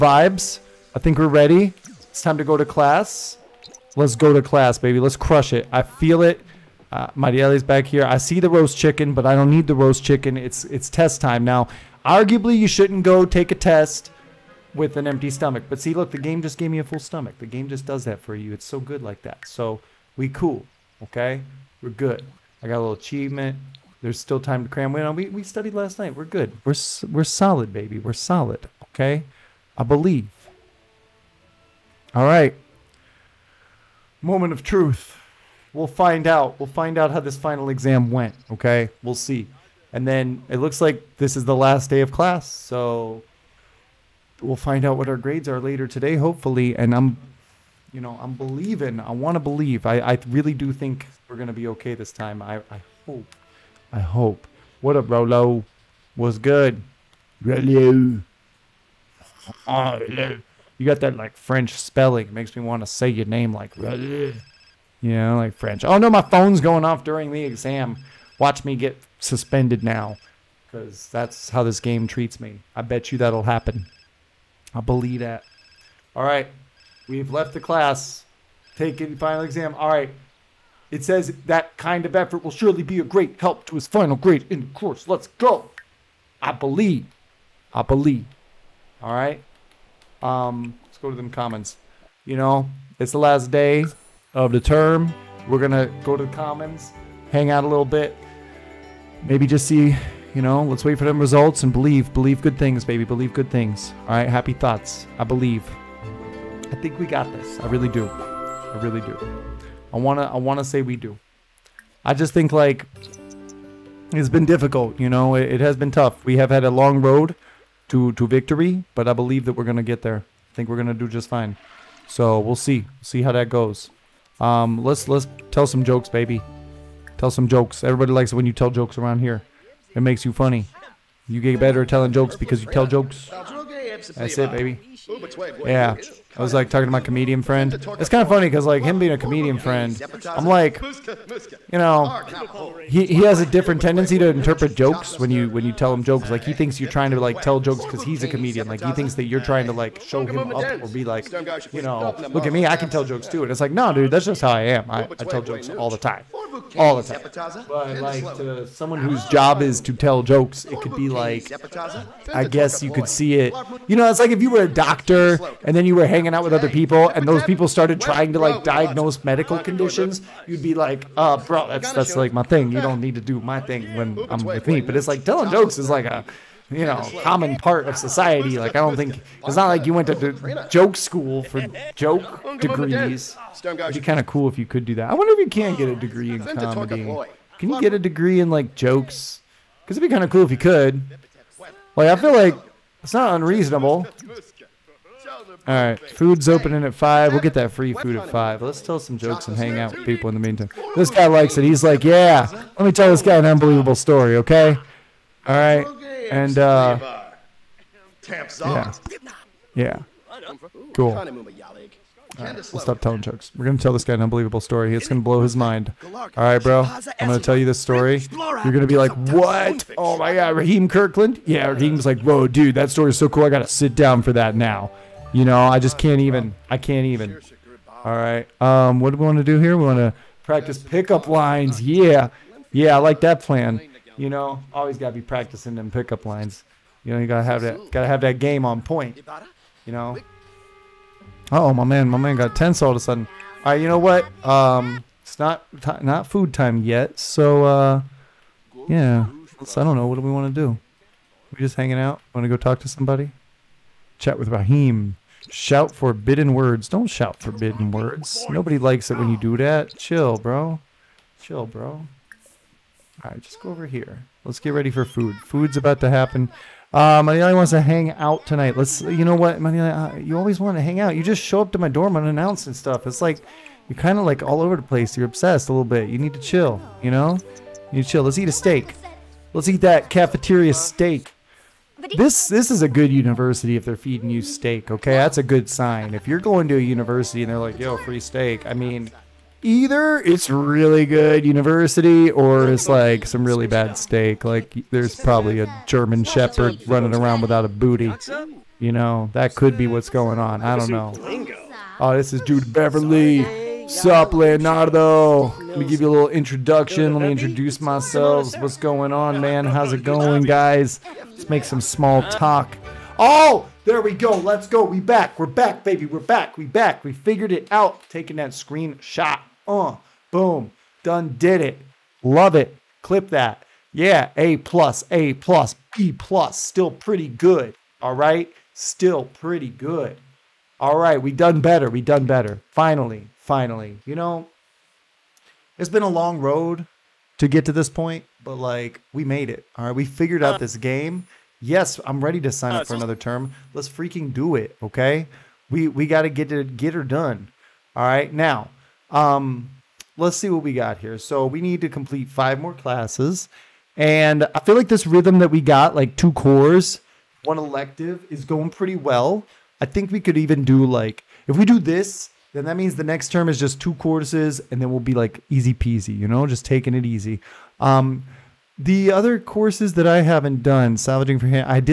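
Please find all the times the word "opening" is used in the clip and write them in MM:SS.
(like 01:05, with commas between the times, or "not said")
03:16.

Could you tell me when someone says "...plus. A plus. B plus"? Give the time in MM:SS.
05:24.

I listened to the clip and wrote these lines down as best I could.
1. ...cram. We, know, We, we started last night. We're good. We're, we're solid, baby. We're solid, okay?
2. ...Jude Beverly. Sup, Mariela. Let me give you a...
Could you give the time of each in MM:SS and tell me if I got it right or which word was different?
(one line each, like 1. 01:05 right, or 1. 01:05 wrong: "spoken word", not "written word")
1. 00:24 wrong: "studied", not "started"
2. 05:02 wrong: "Leonardo", not "Mariela".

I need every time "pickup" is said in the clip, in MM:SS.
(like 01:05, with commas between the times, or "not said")
03:50, 03:55.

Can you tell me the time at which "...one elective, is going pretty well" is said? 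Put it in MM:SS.
05:57.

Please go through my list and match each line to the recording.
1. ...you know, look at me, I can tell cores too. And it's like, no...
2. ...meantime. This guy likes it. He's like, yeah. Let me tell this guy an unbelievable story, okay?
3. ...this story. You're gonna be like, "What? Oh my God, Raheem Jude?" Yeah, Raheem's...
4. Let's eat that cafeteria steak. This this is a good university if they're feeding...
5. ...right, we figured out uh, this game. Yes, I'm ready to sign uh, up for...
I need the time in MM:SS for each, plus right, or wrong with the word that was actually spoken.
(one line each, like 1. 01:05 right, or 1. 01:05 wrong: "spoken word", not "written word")
1. 02:31 wrong: "jokes", not "cores"
2. 03:20 right
3. 03:37 wrong: "Kirkland", not "Jude"
4. 04:39 right
5. 05:39 right.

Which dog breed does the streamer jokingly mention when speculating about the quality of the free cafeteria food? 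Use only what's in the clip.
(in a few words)
German Shepherd.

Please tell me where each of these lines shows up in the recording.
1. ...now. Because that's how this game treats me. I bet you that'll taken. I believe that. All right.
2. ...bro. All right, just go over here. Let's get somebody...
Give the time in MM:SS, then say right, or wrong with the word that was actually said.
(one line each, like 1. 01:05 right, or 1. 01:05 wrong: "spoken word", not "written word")
1. 01:09 wrong: "happen", not "taken"
2. 04:21 wrong: "ready", not "somebody".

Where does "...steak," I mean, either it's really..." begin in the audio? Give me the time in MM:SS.
04:48.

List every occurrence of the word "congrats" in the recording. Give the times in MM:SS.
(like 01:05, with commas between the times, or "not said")
not said.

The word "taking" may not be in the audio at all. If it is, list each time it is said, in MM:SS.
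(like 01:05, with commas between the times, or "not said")
05:18, 06:06.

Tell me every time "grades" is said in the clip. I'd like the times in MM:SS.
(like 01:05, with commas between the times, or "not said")
00:45, 01:24.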